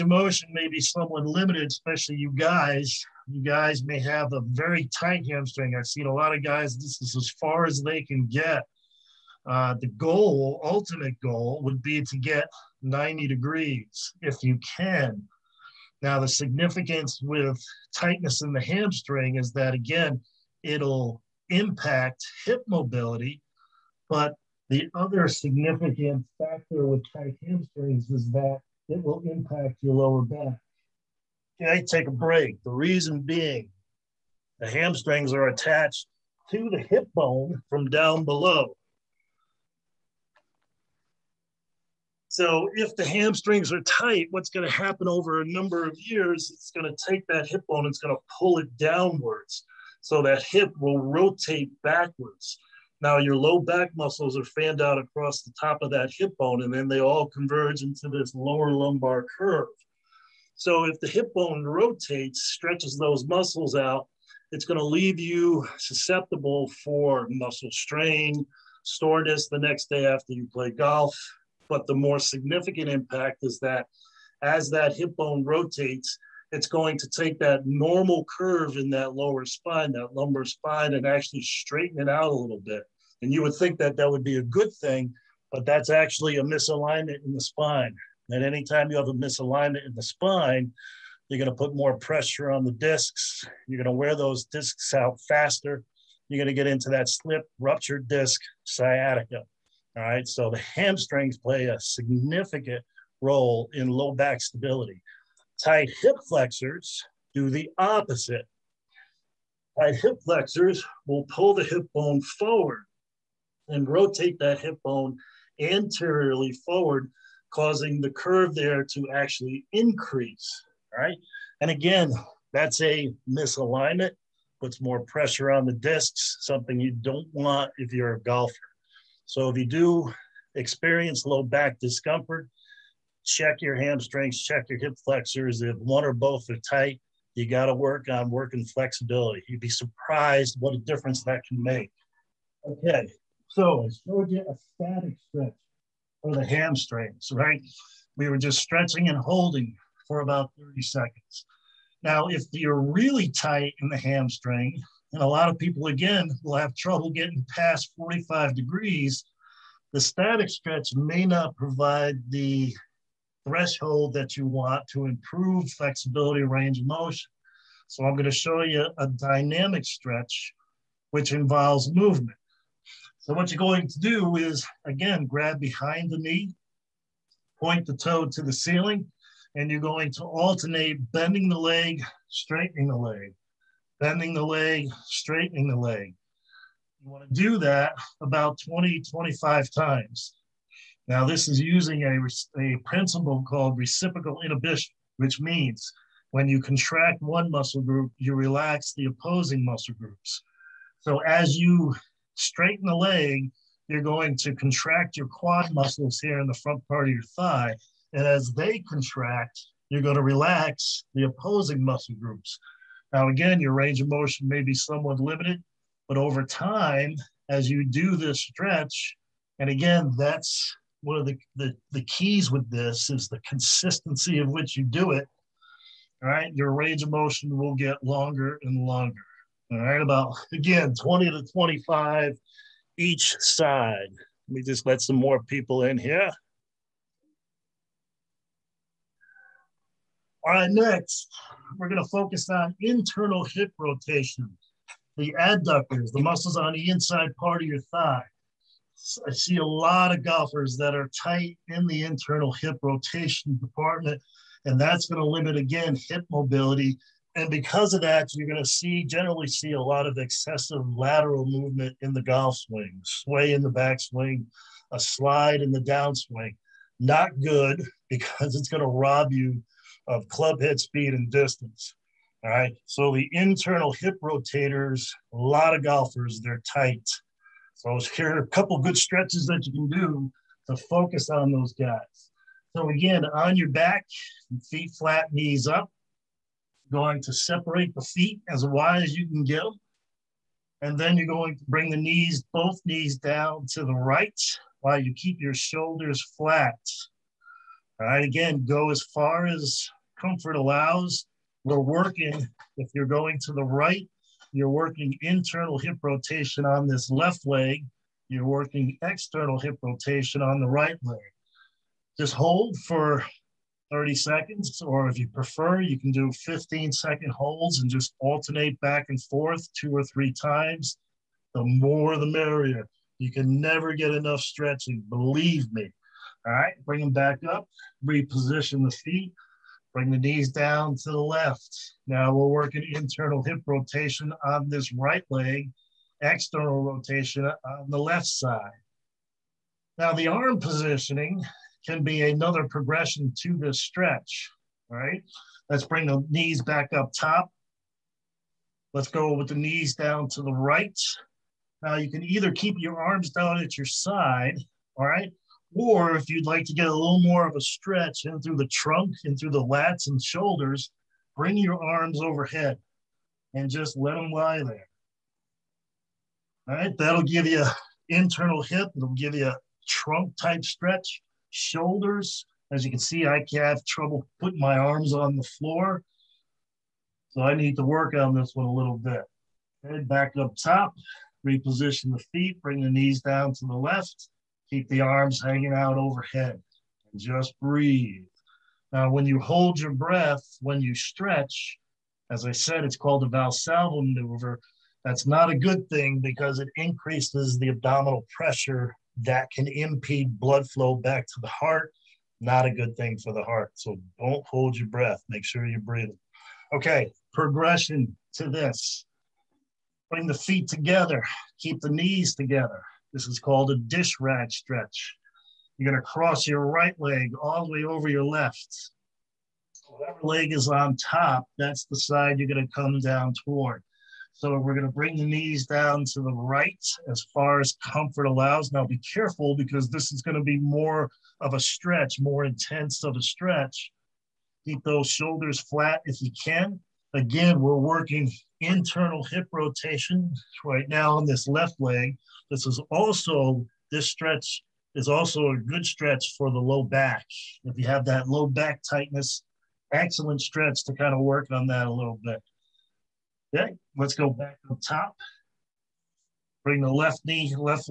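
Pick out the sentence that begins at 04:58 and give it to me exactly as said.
All right, again, go as far as comfort allows.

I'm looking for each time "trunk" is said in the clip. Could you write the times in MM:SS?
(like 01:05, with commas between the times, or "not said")
05:58, 06:09.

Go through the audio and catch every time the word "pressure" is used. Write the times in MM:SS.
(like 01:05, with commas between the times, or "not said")
01:31, 02:05, 06:38.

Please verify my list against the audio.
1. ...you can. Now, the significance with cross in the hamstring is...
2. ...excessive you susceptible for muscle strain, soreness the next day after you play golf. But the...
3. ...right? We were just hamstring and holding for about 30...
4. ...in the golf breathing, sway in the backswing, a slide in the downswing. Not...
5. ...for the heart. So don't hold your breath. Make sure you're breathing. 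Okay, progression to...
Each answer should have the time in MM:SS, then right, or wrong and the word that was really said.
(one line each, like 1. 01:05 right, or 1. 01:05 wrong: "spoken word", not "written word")
1. 00:14 wrong: "tightness", not "cross"
2. 01:04 wrong: "leave", not "excessive"
3. 02:27 wrong: "stretching", not "hamstring"
4. 04:22 wrong: "swing", not "breathing"
5. 06:43 right.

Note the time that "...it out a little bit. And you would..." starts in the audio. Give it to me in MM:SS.
01:22.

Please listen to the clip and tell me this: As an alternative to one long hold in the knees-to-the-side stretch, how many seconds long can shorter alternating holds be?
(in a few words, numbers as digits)
15 seconds.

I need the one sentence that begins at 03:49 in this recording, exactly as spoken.
All right, about again 20 to 25 each side.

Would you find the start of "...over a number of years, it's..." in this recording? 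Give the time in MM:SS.
00:45.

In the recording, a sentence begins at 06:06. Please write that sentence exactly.
All right, that'll give you internal hip.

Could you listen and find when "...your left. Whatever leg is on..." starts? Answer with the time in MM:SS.
06:58.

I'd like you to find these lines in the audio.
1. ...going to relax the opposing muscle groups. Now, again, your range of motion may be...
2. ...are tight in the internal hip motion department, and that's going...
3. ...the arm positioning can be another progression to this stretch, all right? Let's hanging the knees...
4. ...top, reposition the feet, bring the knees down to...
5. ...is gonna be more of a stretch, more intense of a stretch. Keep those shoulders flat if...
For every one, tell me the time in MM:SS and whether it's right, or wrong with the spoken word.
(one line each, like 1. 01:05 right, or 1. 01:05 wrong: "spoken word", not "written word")
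1. 03:30 right
2. 04:10 wrong: "rotation", not "motion"
3. 05:40 wrong: "bring", not "hanging"
4. 06:20 right
5. 07:10 right.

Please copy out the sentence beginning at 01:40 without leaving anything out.
So the hamstrings play a significant role in low back stability.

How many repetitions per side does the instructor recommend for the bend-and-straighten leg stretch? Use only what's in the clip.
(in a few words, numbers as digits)
20 to 25.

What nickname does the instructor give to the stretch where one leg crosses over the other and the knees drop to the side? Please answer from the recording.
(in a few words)
Dish rag stretch.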